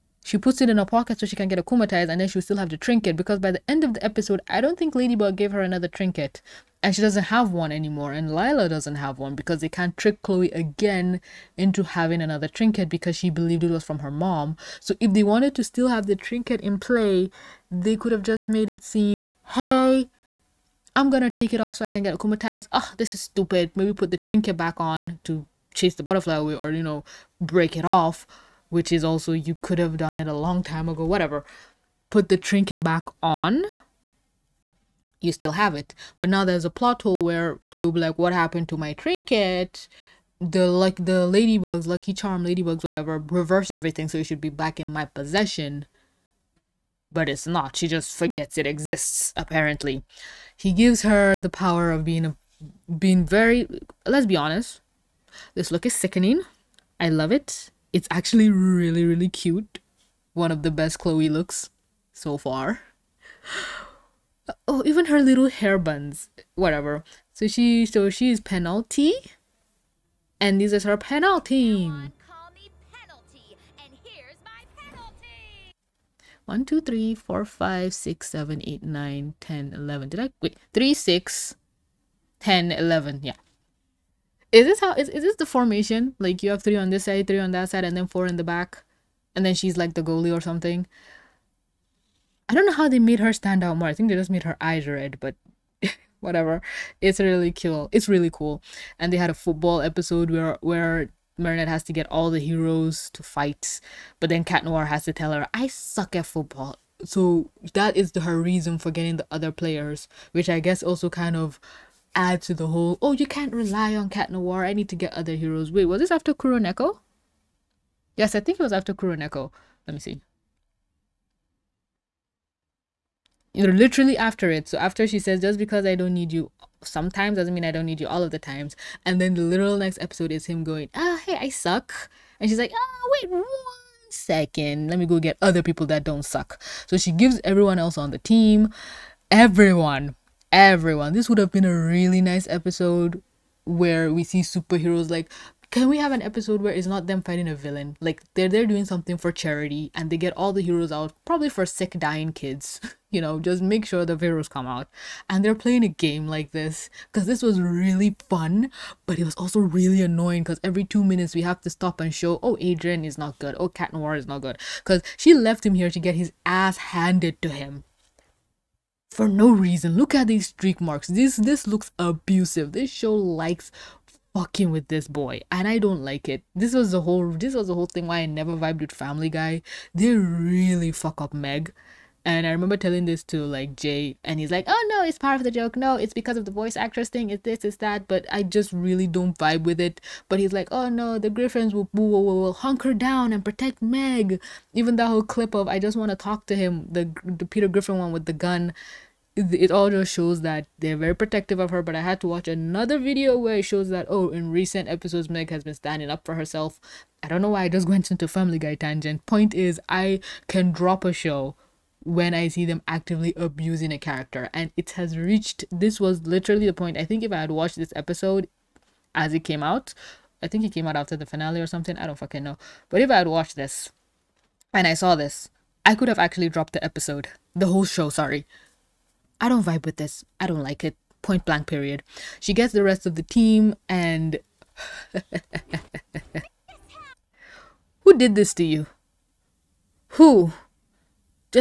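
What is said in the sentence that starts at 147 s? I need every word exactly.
Like they're they're doing something for charity and they get all the heroes out, probably for sick dying kids.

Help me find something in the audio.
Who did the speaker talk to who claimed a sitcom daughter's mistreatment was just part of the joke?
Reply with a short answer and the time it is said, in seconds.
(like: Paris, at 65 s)
Jay, at 183 s.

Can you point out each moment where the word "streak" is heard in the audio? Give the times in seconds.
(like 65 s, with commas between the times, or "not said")
170 s.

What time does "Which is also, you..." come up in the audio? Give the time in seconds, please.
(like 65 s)
28 s.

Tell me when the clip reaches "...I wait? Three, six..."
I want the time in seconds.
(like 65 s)
80 s.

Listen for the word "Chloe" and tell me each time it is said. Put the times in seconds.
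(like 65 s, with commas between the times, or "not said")
10 s, 37 s, 60 s.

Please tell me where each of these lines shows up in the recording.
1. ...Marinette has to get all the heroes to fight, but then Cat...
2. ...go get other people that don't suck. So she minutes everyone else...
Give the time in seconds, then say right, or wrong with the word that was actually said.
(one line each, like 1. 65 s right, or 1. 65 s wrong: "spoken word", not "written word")
1. 101 s right
2. 135 s wrong: "gives", not "minutes".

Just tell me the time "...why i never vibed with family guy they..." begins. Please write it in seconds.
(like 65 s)
178 s.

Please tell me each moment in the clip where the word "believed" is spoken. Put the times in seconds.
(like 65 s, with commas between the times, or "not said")
13 s.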